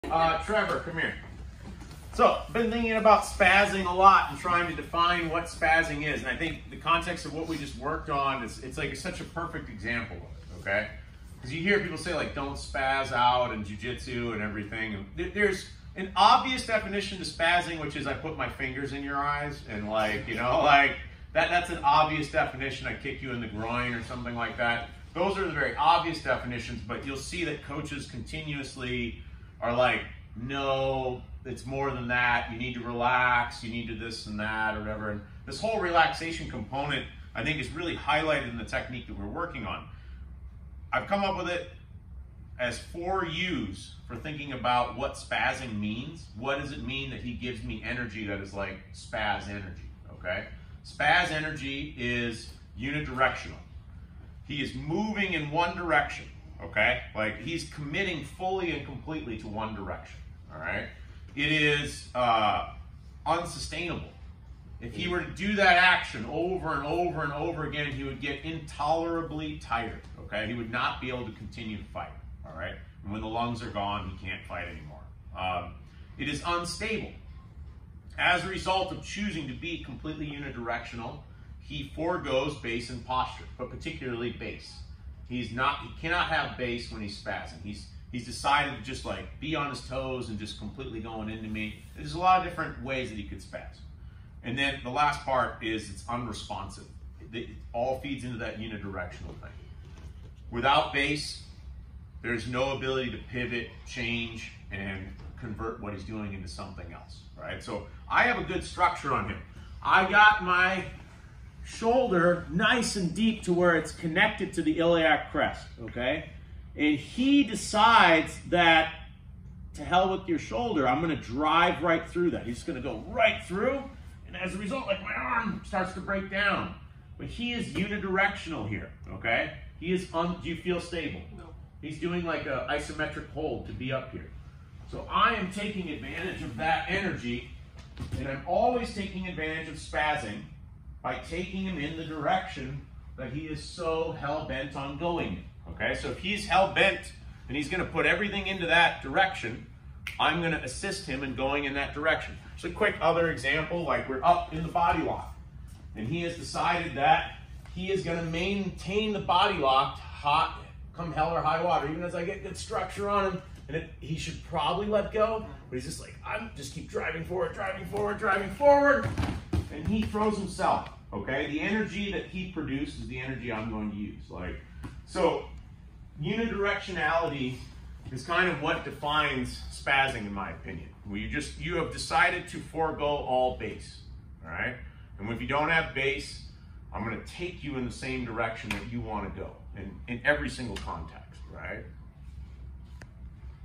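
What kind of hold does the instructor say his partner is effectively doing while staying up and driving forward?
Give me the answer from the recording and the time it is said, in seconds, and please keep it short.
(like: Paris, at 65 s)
Isometric hold, at 132 s.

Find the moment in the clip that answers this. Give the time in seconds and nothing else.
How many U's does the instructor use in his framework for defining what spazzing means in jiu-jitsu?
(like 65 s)
42 s.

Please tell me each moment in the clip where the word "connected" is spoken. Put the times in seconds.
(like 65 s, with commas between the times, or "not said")
113 s.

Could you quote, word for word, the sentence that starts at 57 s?
Like he's committing fully and completely to one direction, all right?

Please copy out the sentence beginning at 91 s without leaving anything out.
There's a lot of different ways that he could spaz.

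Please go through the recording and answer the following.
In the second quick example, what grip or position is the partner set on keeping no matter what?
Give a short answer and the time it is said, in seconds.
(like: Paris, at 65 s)
Body lock, at 154 s.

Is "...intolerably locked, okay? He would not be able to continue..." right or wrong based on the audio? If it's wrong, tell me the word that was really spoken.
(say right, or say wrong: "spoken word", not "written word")
wrong: "tired", not "locked".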